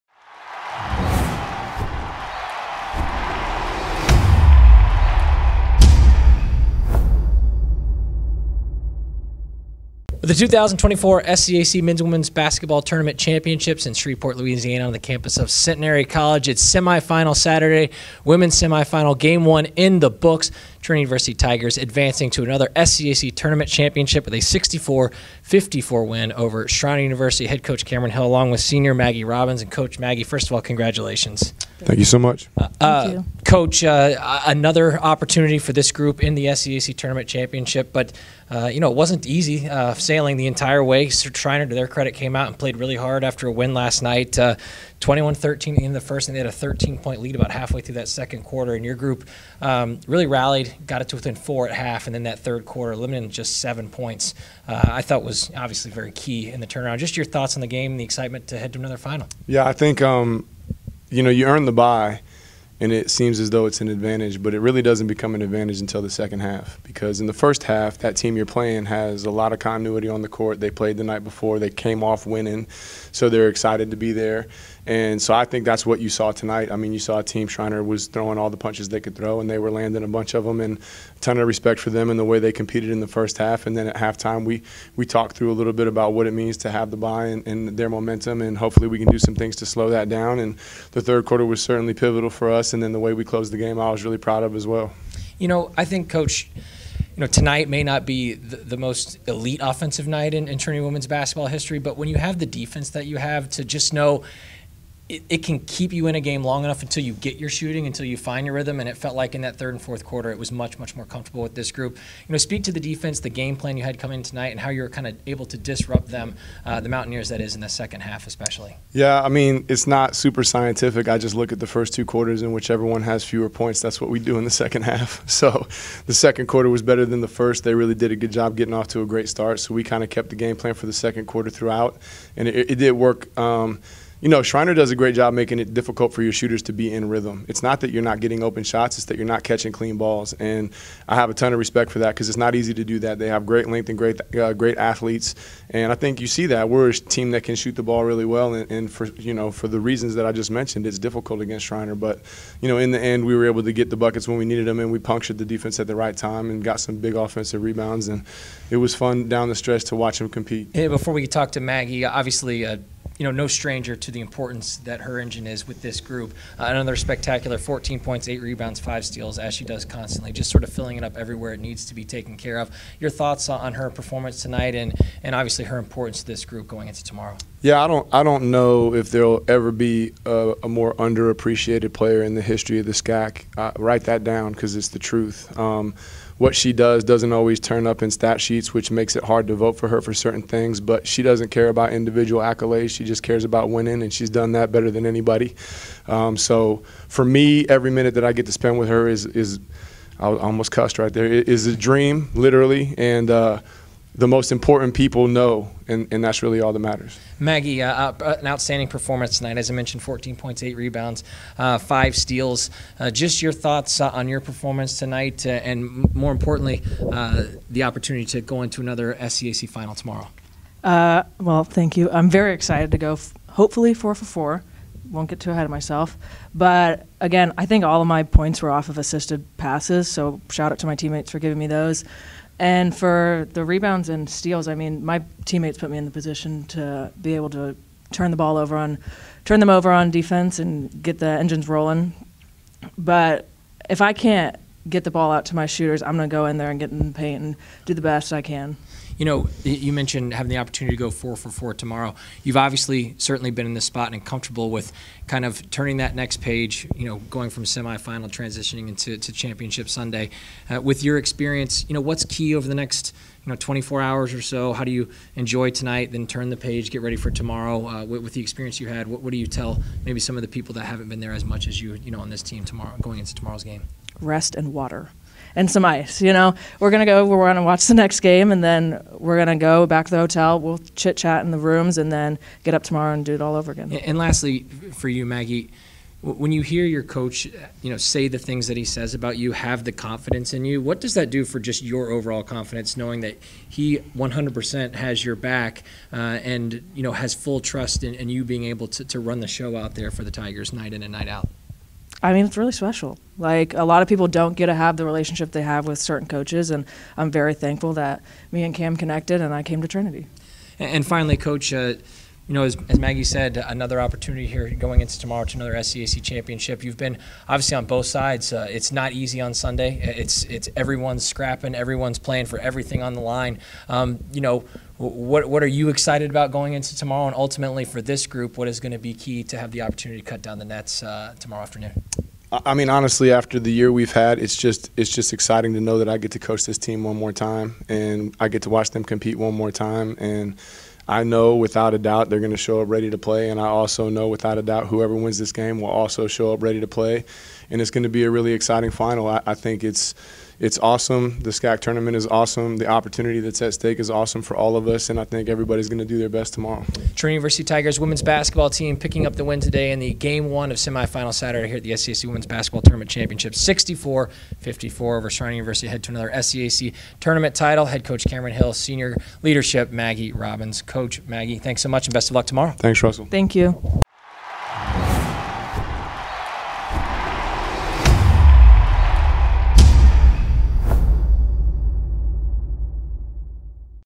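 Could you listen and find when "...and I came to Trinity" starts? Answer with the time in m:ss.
5:09.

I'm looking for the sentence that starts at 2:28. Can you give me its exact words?
And, and for, you know, for the reasons that I just mentioned, it's difficult against Schreiner.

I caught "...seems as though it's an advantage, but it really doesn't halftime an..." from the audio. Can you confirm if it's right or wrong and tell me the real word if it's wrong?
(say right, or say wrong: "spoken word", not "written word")
wrong: "become", not "halftime".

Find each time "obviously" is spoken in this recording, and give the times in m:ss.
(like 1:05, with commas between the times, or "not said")
0:55, 2:42, 2:55, 4:12, 5:17.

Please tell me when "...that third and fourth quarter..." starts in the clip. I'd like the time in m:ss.
1:49.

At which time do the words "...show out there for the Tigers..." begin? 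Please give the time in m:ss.
4:59.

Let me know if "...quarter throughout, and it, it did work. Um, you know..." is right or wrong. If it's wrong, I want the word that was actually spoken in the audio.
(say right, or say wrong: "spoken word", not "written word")
right.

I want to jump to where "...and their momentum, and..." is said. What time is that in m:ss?
1:27.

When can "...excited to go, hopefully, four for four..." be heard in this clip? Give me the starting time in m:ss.
3:42.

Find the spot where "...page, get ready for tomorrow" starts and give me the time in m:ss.
4:26.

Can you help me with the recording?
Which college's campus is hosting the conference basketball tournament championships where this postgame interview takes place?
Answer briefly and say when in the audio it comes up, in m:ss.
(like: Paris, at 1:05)
Centenary College, at 0:15.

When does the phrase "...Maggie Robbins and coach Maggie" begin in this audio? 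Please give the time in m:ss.
0:28.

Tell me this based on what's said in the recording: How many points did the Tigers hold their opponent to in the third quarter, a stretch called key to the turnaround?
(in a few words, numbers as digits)
7.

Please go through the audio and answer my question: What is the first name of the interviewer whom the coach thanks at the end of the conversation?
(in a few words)
Russell.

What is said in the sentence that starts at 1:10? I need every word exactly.
They played the night before, they came off winning, so they're excited to be there.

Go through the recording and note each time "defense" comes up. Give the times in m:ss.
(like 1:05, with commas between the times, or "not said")
1:42, 1:52, 2:35, 4:00.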